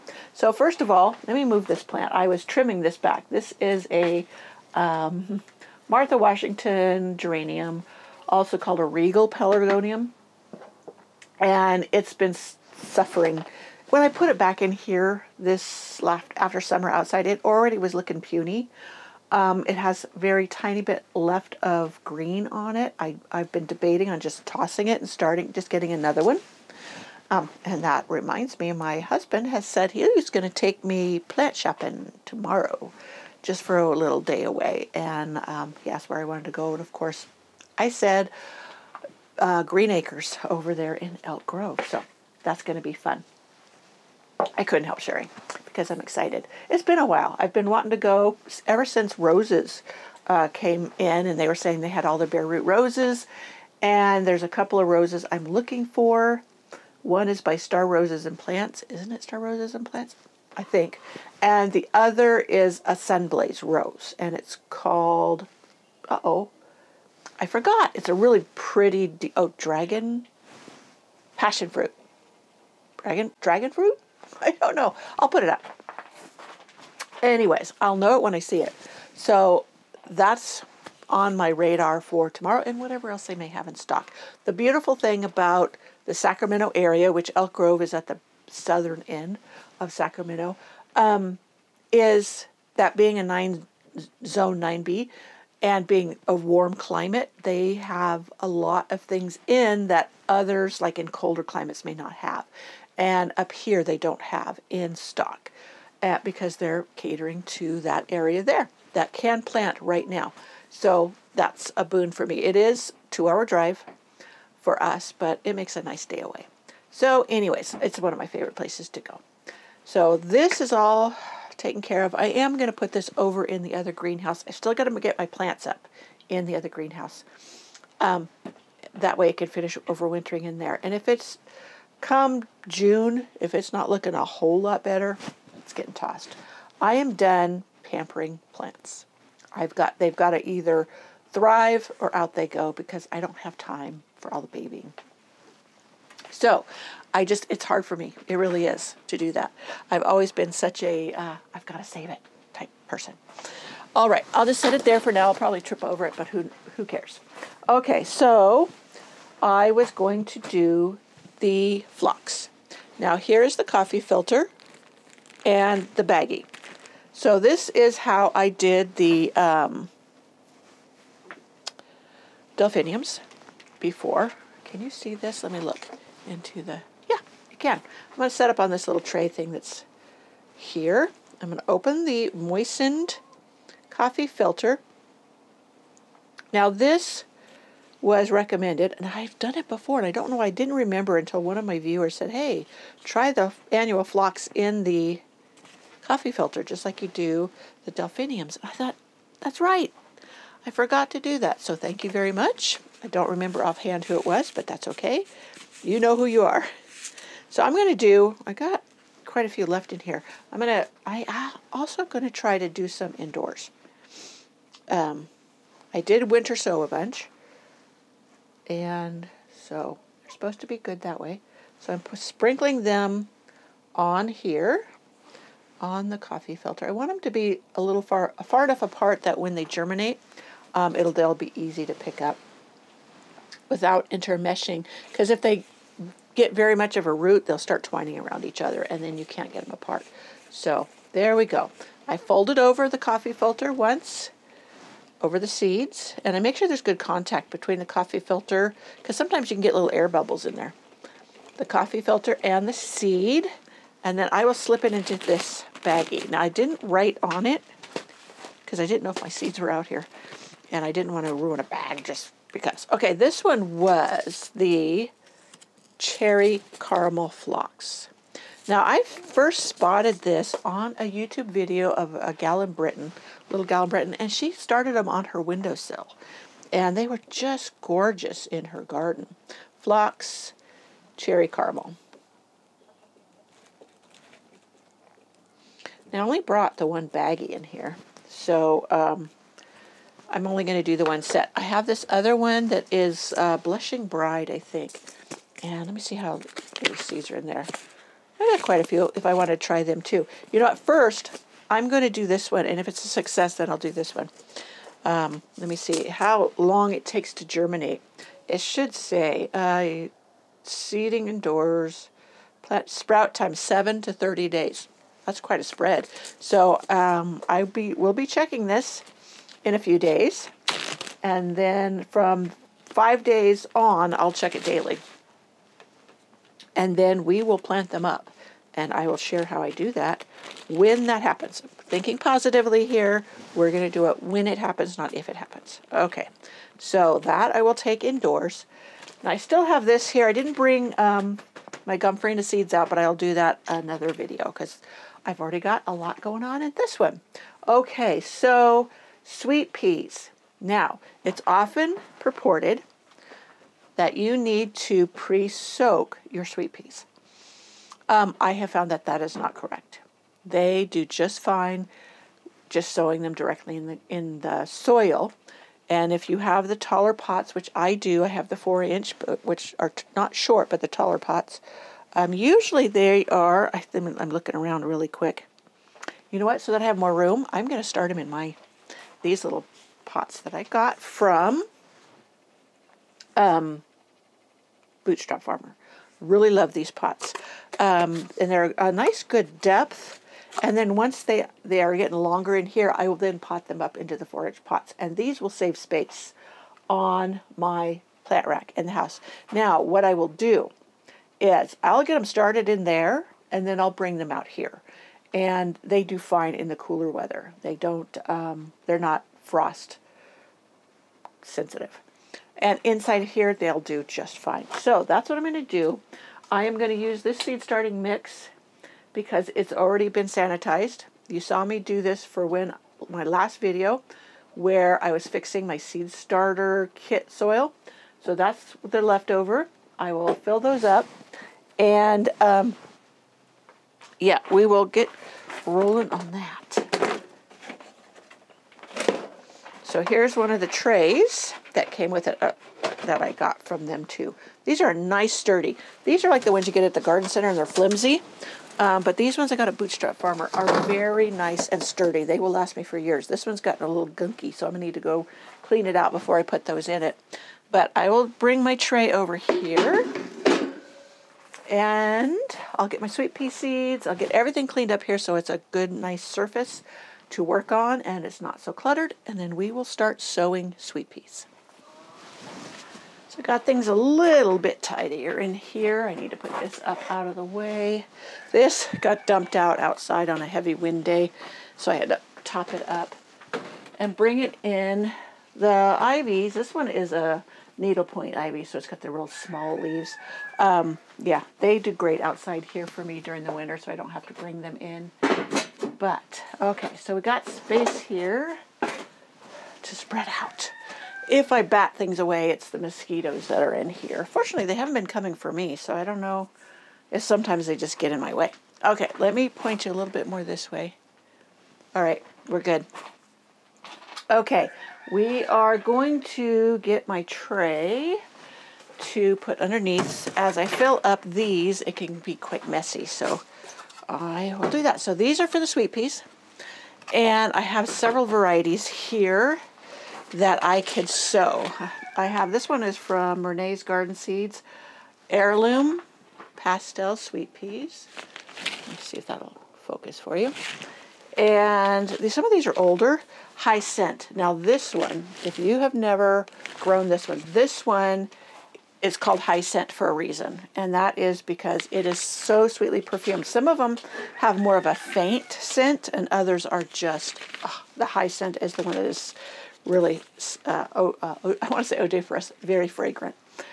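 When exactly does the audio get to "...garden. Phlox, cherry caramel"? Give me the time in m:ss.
4:38.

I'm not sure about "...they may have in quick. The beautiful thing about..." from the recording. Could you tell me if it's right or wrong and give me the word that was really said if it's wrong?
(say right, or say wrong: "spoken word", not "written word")
wrong: "stock", not "quick".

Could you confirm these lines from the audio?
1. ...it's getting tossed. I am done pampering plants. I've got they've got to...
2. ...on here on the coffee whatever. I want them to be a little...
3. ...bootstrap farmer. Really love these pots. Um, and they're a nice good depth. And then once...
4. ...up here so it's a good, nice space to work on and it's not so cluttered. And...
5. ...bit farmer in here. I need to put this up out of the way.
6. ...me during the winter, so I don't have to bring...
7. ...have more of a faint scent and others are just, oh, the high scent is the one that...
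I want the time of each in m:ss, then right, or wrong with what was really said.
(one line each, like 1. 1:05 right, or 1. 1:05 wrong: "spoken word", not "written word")
1. 2:15 right
2. 3:43 wrong: "filter", not "whatever"
3. 6:25 right
4. 7:44 wrong: "surface", not "space"
5. 7:54 wrong: "tidier", not "farmer"
6. 8:13 right
7. 9:14 right.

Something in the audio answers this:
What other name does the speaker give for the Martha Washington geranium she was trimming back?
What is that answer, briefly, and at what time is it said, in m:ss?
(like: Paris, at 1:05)
regal pelargonium, at 0:08.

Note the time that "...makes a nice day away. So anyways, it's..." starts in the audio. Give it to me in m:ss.
1:55.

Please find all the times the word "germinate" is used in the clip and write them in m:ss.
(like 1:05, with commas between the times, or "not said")
3:49, 5:07.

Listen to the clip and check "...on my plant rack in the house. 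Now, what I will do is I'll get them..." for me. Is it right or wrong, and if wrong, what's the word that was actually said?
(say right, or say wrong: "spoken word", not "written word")
right.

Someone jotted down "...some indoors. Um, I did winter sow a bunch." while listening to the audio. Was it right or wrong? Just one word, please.
right.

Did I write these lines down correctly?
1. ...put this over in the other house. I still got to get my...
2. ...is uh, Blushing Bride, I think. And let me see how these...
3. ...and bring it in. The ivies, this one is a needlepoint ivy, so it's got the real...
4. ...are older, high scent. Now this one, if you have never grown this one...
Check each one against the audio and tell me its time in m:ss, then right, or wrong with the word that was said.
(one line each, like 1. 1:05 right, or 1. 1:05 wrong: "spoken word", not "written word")
1. 2:02 wrong: "greenhouse", not "house"
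2. 4:52 right
3. 8:03 right
4. 9:02 right.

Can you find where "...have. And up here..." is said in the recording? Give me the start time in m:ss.
1:42.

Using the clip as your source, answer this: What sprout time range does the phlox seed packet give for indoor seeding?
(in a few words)
7 to 30 days.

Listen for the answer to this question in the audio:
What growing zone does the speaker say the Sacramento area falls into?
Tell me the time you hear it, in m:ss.
1:34.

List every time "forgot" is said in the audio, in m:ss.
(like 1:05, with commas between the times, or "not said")
1:07, 3:20.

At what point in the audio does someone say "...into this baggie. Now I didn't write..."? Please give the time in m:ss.
4:14.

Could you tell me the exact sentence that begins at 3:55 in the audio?
Because if they get very much of a root, they'll start twining around each other, and then you can't get them apart.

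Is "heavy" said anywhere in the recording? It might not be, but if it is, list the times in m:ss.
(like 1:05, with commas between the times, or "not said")
8:00.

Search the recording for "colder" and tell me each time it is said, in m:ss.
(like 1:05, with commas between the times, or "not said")
1:41.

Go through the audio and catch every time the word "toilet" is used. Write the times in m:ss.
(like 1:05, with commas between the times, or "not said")
not said.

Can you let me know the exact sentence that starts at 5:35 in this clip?
Okay, so that I will take indoors.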